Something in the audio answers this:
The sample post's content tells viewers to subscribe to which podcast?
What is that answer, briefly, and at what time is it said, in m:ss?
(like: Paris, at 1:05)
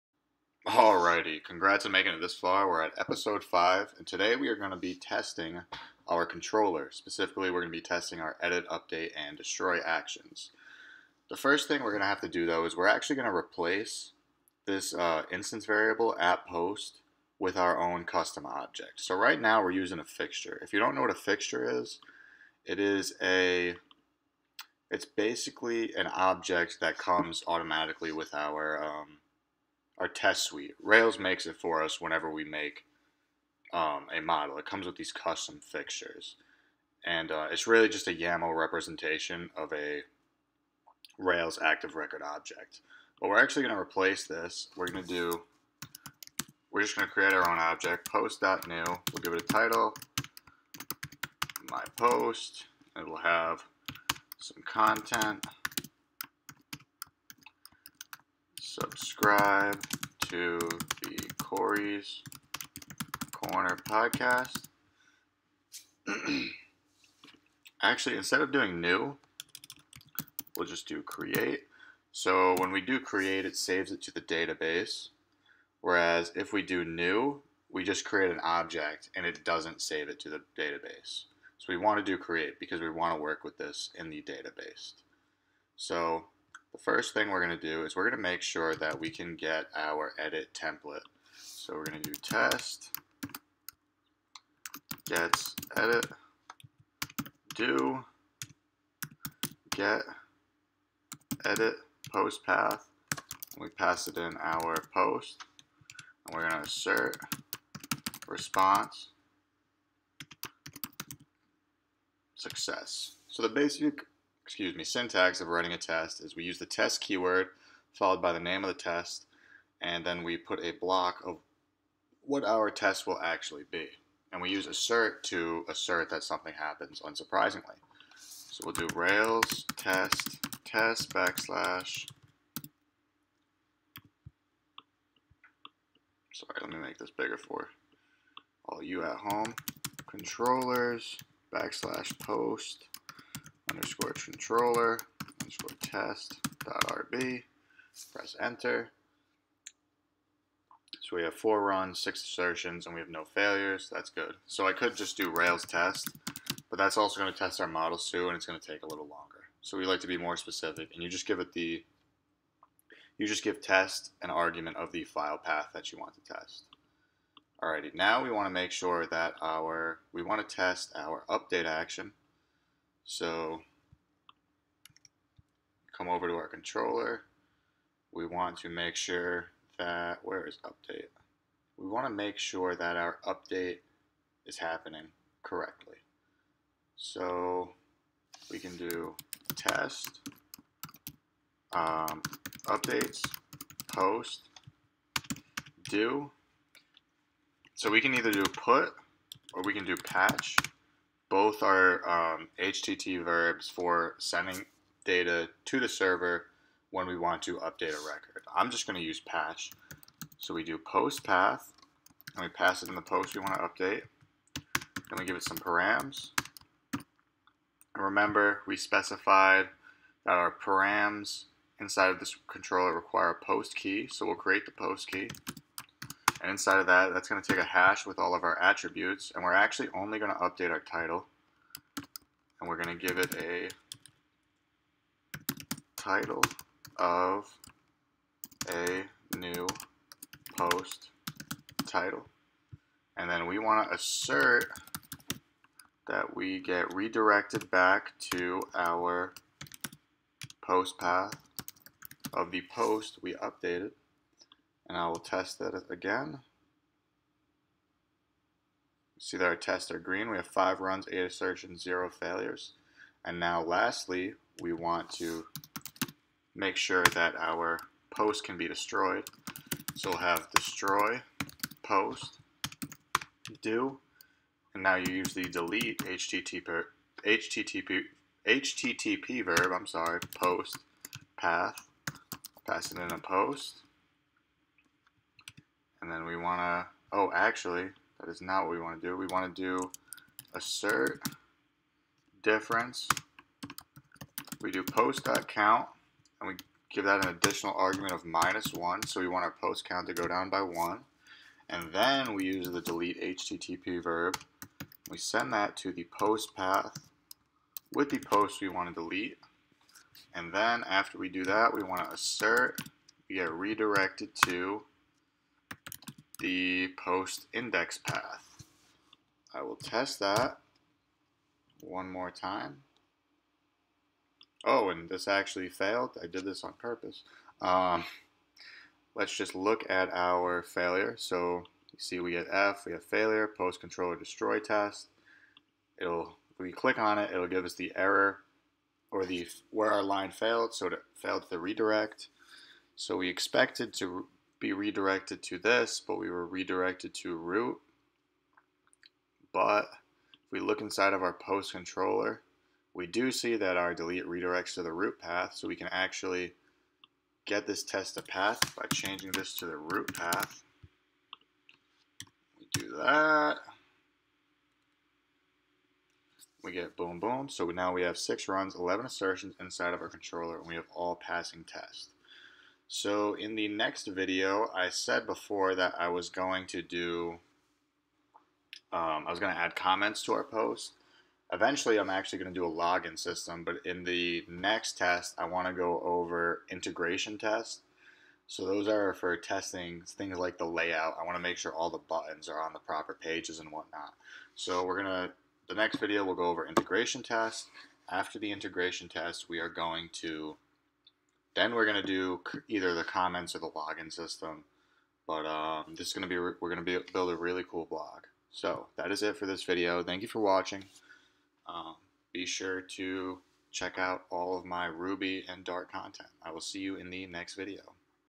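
Corey's Corner, at 1:01.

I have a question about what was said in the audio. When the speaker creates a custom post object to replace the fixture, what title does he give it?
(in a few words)
my post.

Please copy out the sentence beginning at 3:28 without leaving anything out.
I'm just going to use patch.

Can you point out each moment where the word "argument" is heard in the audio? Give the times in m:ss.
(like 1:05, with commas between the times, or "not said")
2:44, 4:57.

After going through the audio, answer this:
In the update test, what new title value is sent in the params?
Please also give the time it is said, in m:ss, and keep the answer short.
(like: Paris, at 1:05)
a new post title, at 3:58.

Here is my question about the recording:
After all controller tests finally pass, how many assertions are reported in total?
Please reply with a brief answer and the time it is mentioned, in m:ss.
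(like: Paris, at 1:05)
11, at 6:08.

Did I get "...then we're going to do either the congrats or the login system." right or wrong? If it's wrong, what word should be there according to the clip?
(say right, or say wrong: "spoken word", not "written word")
wrong: "comments", not "congrats".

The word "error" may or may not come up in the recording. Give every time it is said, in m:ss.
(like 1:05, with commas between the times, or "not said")
5:37.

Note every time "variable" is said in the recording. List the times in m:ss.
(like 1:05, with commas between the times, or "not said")
0:15.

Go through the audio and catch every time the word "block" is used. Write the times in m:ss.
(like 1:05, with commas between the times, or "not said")
2:00.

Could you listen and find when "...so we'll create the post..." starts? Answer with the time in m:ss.
3:44.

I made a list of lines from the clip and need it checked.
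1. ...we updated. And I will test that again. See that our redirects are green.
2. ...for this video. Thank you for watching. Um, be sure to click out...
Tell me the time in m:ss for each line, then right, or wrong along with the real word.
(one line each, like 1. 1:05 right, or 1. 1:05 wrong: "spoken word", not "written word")
1. 4:13 wrong: "tests", not "redirects"
2. 6:49 wrong: "check", not "click".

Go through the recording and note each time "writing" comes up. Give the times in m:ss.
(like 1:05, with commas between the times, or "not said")
1:55.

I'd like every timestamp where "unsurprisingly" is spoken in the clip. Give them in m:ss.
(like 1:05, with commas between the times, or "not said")
2:06.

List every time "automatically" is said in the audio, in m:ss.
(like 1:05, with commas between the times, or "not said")
0:27.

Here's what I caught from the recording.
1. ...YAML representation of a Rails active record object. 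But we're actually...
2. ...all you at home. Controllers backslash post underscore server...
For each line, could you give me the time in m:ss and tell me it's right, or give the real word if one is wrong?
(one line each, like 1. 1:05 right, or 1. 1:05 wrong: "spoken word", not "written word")
1. 0:38 right
2. 2:18 wrong: "controller", not "server".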